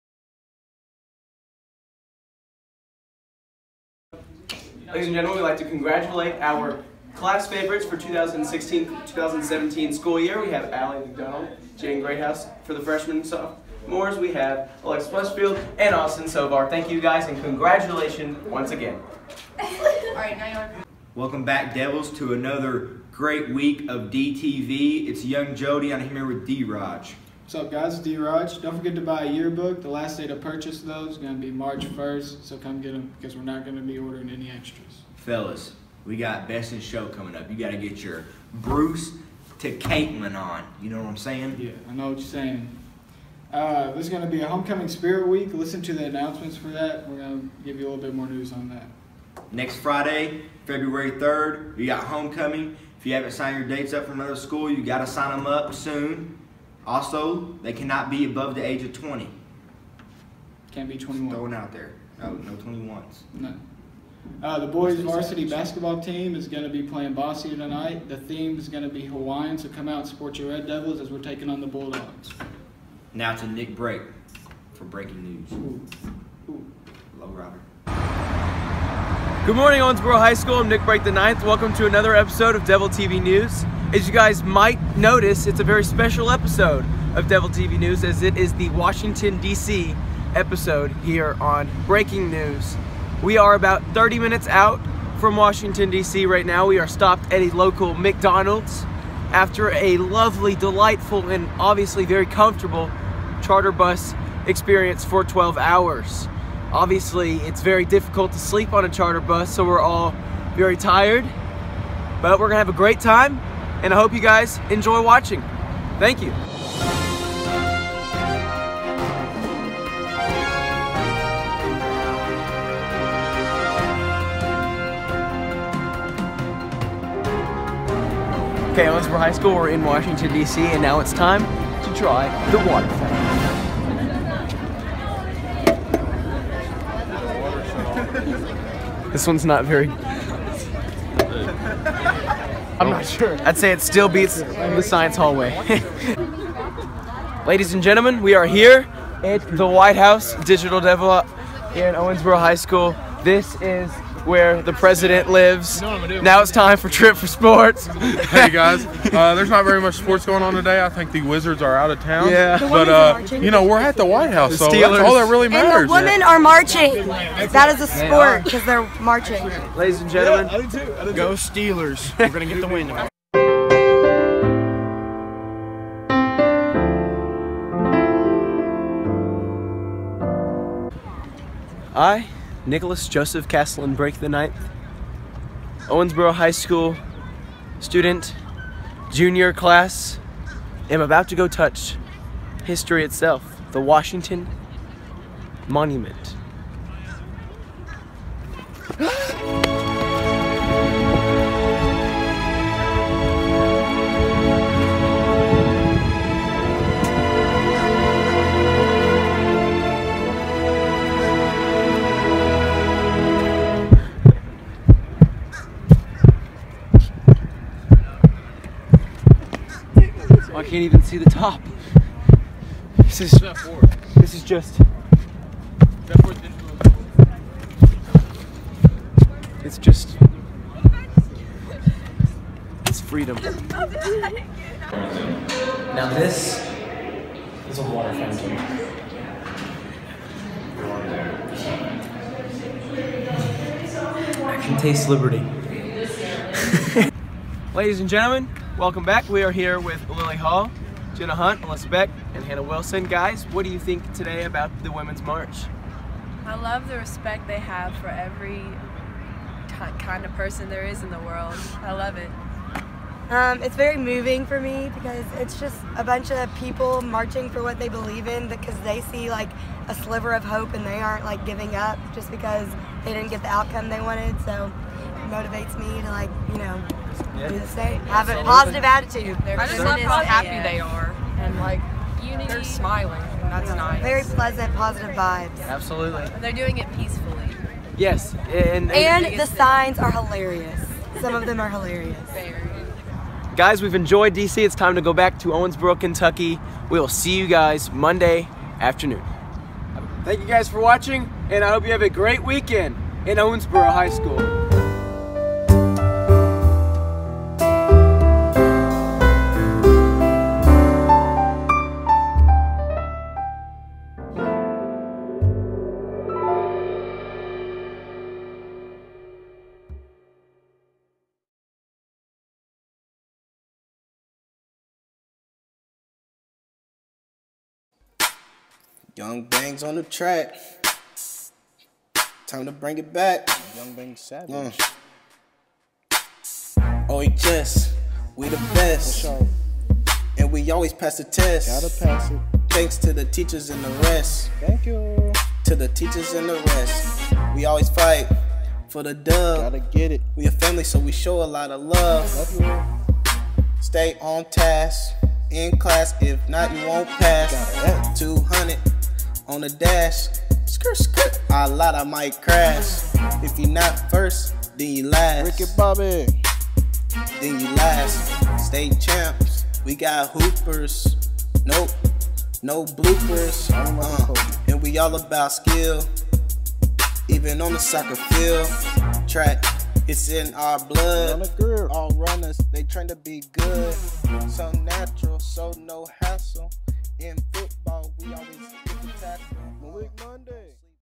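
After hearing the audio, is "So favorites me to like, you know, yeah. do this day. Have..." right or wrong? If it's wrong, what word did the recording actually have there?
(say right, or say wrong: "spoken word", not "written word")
wrong: "motivates", not "favorites".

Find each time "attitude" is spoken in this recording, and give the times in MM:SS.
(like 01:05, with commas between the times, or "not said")
04:38.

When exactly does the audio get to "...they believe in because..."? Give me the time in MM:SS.
04:27.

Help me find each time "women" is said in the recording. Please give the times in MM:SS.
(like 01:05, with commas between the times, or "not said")
02:45, 04:14.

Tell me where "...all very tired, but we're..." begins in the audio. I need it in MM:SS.
01:49.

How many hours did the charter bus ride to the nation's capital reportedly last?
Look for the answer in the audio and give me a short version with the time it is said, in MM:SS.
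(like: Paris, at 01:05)
12 hours, at 01:45.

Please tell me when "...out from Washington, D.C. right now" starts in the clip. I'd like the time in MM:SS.
01:34.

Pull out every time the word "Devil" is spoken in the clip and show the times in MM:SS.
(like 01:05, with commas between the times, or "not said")
00:21, 01:10, 01:22, 01:27, 02:30.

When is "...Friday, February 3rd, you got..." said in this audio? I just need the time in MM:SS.
00:49.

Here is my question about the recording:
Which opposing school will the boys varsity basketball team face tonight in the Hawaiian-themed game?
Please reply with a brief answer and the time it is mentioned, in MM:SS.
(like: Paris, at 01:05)
Bossier, at 01:07.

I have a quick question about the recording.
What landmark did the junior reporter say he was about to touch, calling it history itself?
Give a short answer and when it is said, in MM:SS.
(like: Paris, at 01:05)
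Washington Monument, at 03:13.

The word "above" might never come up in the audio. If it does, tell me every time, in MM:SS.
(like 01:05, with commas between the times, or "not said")
00:58.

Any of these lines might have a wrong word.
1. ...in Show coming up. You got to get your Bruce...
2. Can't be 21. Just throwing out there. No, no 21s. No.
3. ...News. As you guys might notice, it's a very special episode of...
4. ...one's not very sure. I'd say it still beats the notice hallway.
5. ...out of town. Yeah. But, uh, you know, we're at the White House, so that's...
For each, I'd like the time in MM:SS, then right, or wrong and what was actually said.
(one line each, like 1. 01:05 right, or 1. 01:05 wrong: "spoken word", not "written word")
1. 00:36 right
2. 01:00 right
3. 01:23 right
4. 02:19 wrong: "science", not "notice"
5. 02:41 right.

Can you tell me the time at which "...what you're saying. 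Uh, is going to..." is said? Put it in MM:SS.
00:42.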